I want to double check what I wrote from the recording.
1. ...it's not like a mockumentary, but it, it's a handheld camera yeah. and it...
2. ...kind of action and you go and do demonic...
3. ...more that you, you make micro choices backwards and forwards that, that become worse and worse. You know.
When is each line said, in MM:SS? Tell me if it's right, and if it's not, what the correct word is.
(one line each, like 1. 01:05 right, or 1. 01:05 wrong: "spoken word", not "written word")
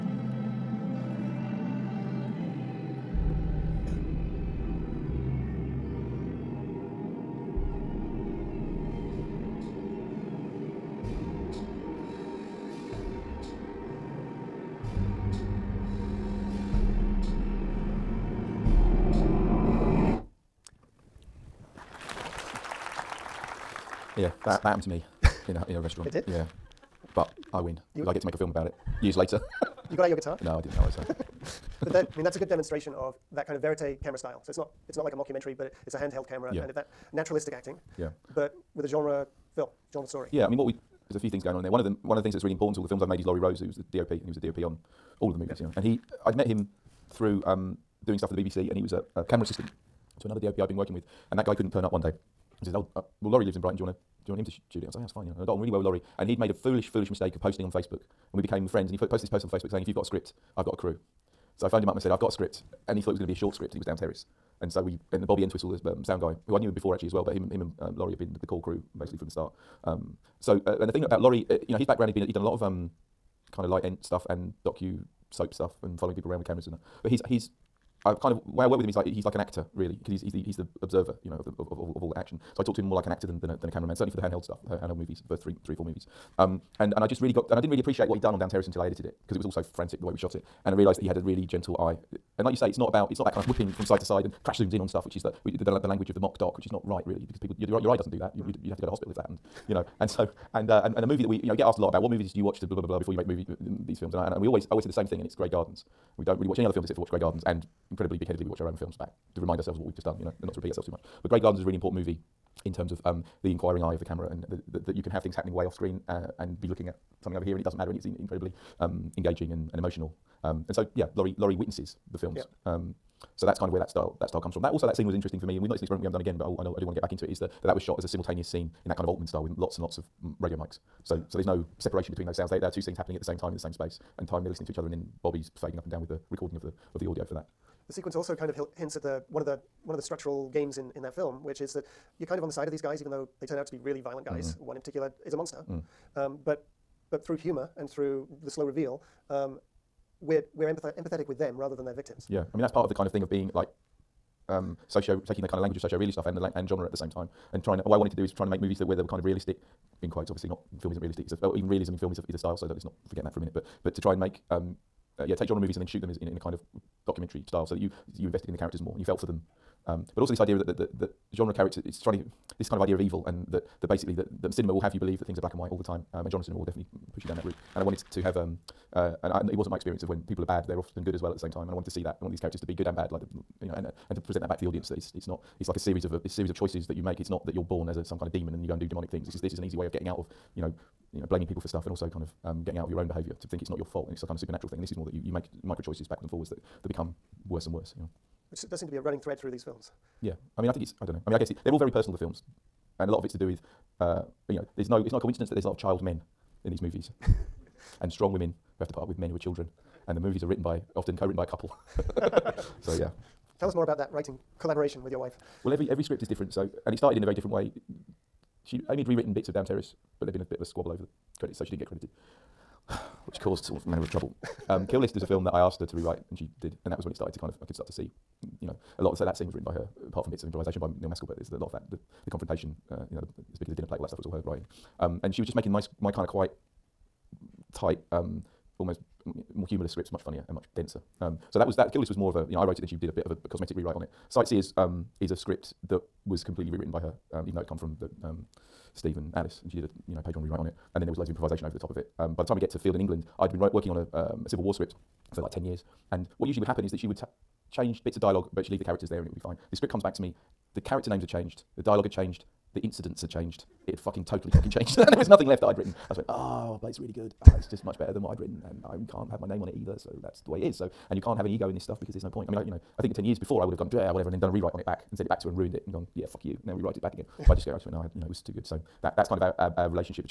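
1. 00:34 right
2. 03:08 wrong: "demon", not "action"
3. 03:14 right.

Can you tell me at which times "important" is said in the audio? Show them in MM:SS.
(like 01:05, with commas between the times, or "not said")
00:42, 01:51.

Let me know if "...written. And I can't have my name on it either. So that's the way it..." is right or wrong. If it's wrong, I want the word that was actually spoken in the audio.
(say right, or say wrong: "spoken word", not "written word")
right.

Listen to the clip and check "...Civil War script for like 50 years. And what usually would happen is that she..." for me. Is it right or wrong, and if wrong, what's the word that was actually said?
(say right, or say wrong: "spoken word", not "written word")
wrong: "10", not "50".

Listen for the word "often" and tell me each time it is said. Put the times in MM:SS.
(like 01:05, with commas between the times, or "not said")
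03:00, 03:30.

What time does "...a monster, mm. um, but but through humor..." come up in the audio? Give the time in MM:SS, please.
02:25.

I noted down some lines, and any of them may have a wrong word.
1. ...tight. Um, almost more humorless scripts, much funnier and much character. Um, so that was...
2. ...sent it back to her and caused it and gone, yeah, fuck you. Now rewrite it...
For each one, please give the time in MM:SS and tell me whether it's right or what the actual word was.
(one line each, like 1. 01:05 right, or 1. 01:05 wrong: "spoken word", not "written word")
1. 03:57 wrong: "denser", not "character"
2. 04:35 wrong: "ruined", not "caused".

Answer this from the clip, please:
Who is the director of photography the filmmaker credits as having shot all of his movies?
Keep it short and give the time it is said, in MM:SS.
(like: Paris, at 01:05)
Laurie Rose, at 00:43.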